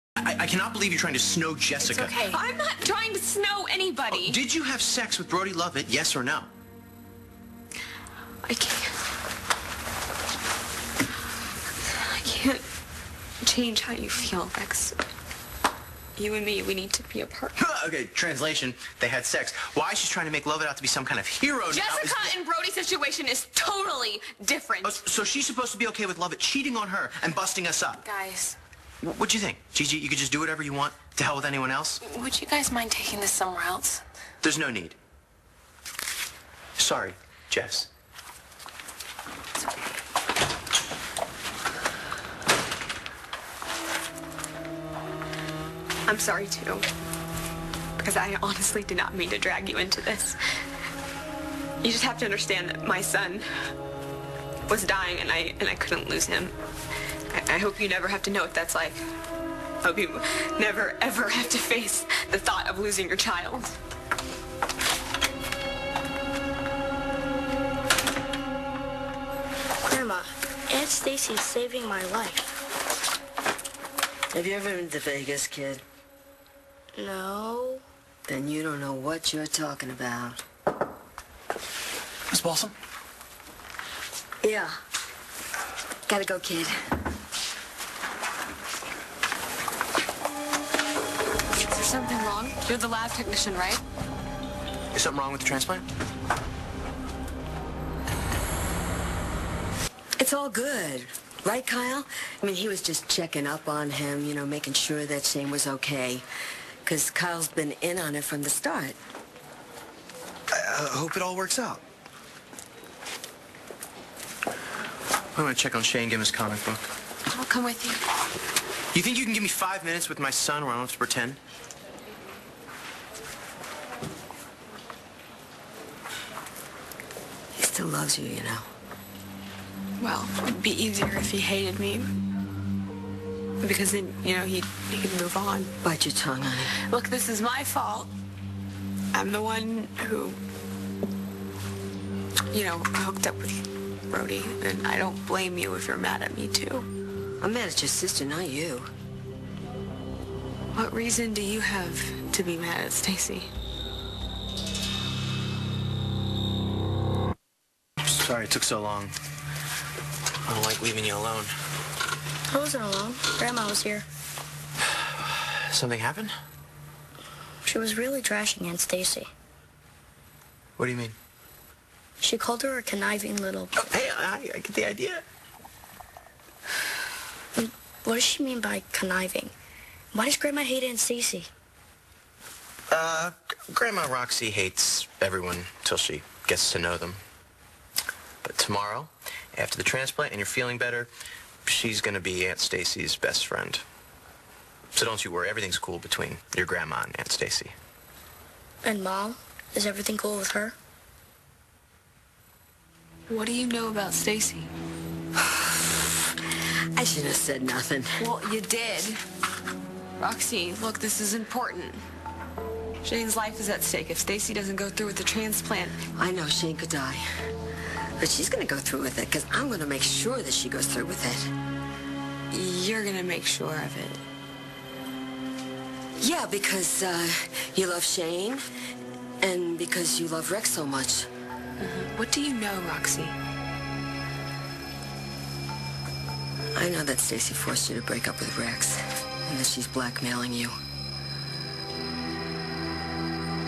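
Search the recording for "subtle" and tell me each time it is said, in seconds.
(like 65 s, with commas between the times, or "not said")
not said.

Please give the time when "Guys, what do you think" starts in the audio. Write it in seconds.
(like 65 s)
28 s.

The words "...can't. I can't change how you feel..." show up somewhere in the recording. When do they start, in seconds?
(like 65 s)
8 s.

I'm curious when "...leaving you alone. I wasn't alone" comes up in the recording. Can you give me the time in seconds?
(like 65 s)
160 s.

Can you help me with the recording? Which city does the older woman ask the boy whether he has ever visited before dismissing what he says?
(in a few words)
Vegas.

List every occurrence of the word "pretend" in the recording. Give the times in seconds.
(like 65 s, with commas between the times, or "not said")
120 s.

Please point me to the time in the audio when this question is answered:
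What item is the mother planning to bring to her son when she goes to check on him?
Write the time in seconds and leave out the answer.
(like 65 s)
116 s.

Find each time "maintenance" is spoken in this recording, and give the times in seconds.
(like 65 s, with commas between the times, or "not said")
not said.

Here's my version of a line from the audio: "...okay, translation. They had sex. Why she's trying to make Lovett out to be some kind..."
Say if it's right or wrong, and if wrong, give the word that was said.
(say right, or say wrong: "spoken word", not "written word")
right.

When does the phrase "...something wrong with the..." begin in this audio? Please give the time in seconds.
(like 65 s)
95 s.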